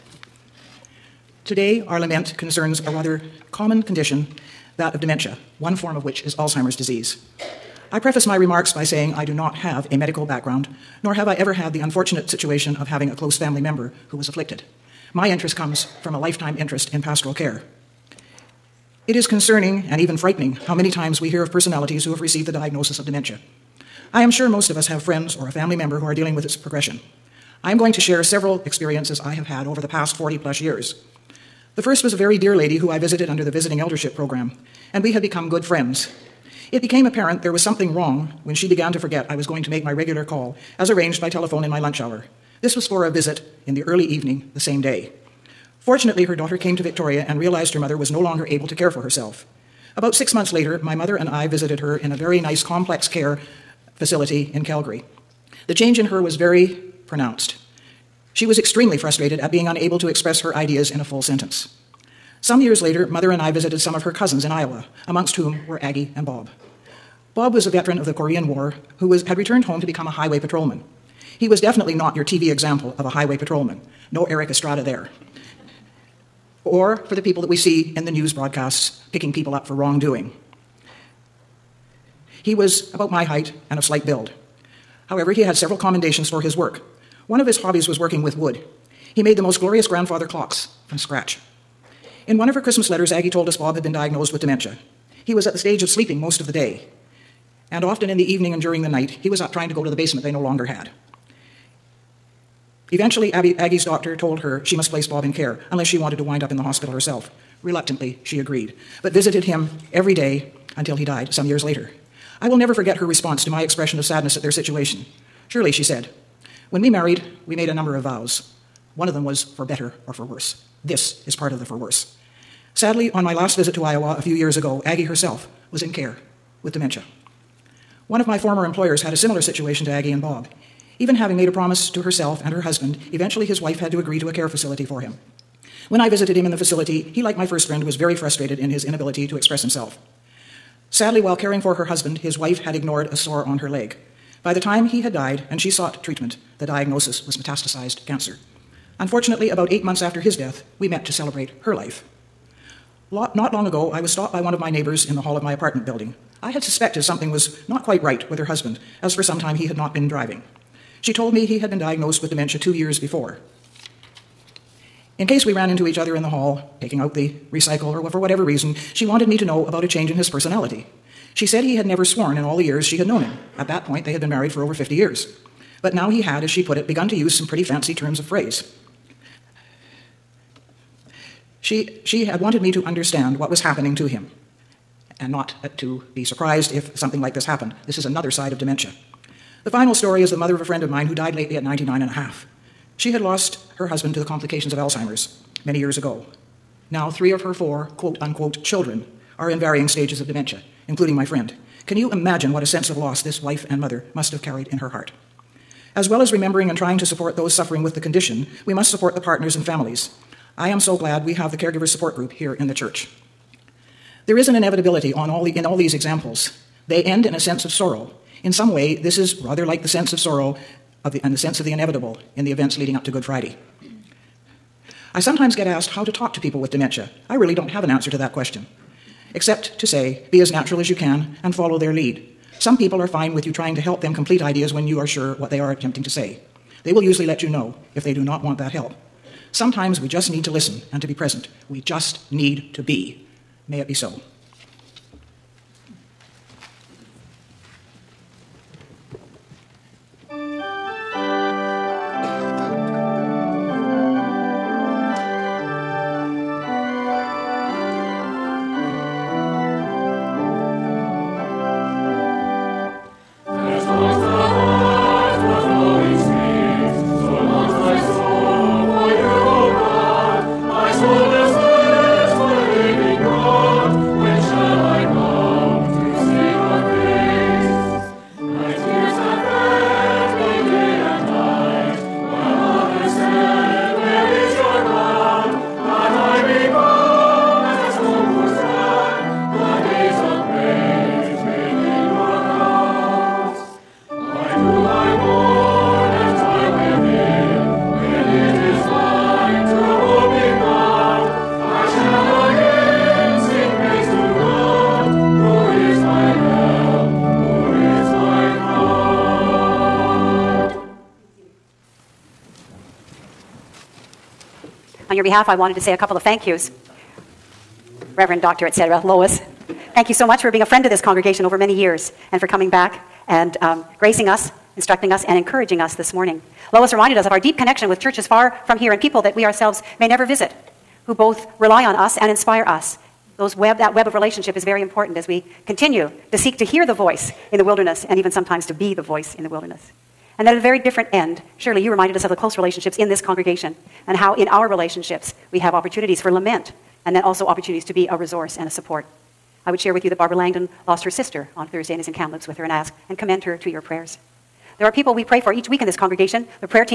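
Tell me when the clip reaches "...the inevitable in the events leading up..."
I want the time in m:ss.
3:41.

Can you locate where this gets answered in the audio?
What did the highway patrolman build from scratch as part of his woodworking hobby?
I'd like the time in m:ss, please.
1:29.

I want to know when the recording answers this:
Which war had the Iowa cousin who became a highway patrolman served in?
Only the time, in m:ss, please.
1:08.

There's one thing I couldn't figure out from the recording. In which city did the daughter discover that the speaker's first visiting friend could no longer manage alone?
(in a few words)
Victoria.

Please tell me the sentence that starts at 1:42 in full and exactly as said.
Eventually, Abby, Aggie's doctor told her she must place Bob in care unless she wanted to wind up in the hospital herself.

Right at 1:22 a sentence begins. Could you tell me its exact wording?
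He was about my height, and of slight build.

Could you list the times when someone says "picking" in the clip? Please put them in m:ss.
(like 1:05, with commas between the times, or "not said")
1:19.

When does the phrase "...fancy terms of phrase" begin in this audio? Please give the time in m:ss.
2:57.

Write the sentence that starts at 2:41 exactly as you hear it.
She told me he had been diagnosed with dementia two years before.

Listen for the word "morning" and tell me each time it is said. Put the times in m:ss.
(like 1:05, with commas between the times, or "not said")
5:26.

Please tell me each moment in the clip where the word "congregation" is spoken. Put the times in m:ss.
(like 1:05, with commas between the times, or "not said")
5:21, 5:43, 5:55.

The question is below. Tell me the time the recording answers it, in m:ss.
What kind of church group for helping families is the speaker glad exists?
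3:31.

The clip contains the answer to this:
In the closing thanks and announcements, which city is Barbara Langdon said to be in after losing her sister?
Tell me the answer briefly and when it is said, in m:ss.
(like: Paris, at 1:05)
Kamloops, at 5:52.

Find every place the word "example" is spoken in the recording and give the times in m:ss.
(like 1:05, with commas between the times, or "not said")
1:12, 3:35.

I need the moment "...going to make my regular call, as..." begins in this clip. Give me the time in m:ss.
0:39.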